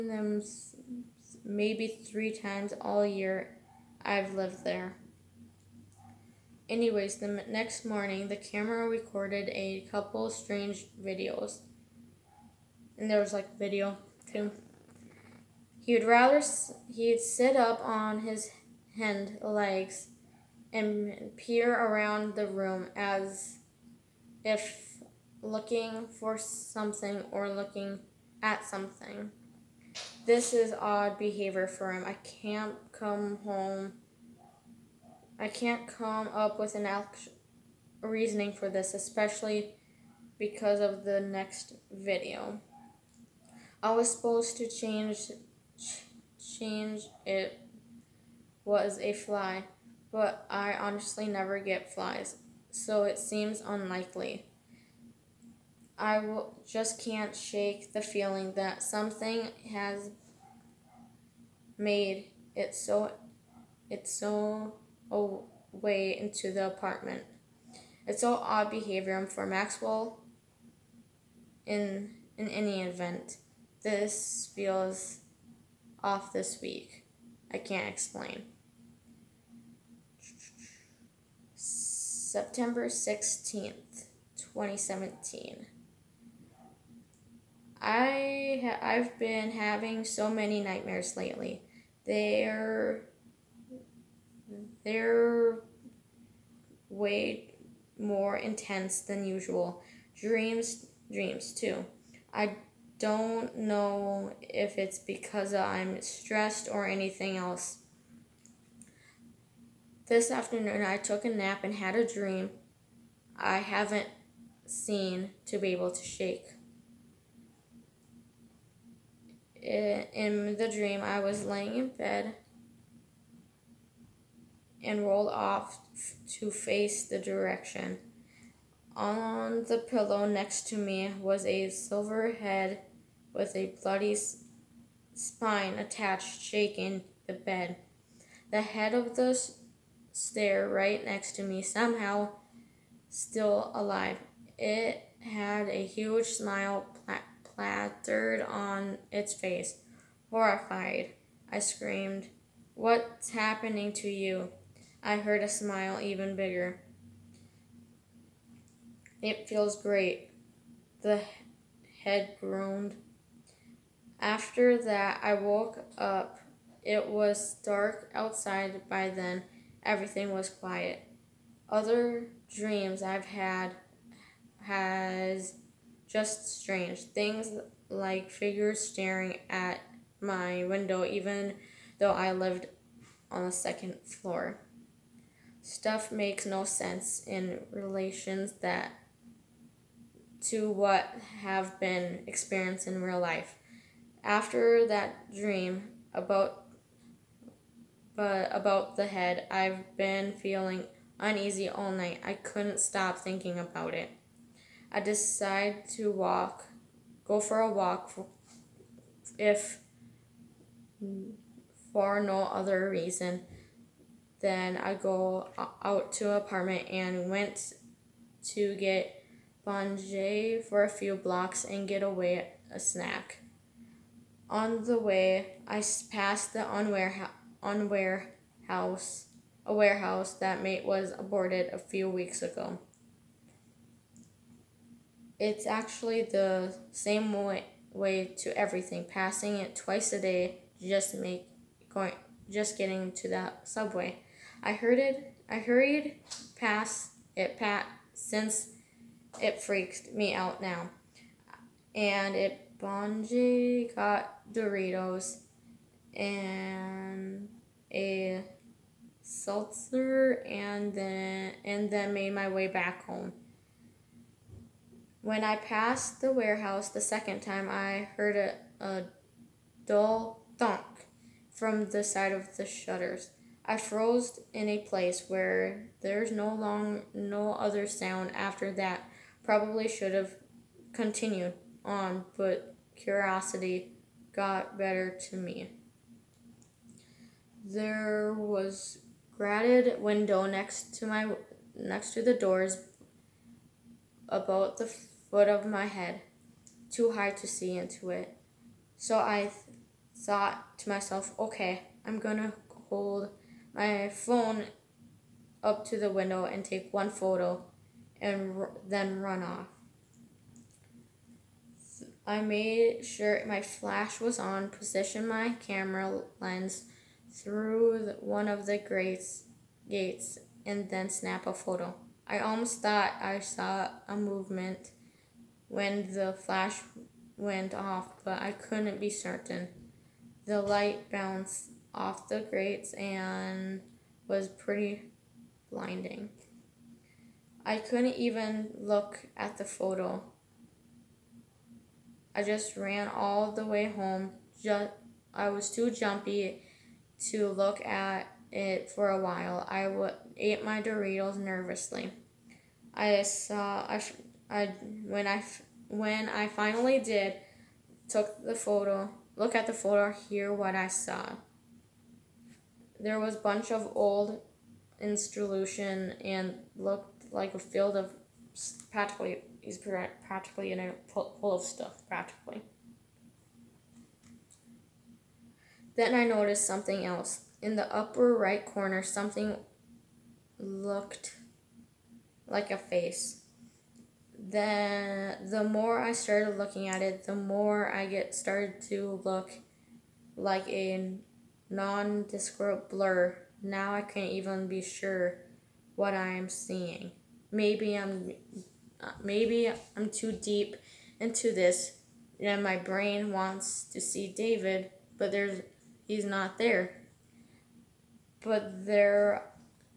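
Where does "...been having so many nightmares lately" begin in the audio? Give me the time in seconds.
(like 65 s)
89 s.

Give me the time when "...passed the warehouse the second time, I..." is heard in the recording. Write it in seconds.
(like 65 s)
265 s.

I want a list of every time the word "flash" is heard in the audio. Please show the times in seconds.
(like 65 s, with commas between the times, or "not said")
313 s, 326 s.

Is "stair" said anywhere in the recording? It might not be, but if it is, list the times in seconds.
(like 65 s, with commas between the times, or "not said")
140 s.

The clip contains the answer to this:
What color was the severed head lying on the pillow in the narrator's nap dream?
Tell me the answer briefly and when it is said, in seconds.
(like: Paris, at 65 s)
silver, at 131 s.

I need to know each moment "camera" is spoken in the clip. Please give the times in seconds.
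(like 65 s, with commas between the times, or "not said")
8 s, 315 s.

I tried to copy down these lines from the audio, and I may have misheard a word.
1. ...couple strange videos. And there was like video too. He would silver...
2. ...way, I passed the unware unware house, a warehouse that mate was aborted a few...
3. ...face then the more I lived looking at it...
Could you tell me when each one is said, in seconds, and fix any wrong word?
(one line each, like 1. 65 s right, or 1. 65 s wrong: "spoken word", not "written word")
1. 9 s wrong: "rather", not "silver"
2. 224 s right
3. 382 s wrong: "started", not "lived".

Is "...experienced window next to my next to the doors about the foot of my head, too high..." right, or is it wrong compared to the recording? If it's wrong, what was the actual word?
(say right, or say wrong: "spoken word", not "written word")
wrong: "grated", not "experienced".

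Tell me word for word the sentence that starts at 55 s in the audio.
I w- just can't shake the feeling that something has made it so it's so away into the apartment.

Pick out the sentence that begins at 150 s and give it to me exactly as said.
Horrified, I screamed, What's happening to you?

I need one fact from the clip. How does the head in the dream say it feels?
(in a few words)
great.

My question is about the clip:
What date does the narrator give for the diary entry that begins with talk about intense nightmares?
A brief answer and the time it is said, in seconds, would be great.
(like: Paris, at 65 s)
September 16th, 2017, at 81 s.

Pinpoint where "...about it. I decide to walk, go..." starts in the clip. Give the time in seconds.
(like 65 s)
203 s.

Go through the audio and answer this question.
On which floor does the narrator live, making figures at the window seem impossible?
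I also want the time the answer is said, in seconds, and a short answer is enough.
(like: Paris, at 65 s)
second floor, at 183 s.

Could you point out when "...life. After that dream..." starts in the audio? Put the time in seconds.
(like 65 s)
193 s.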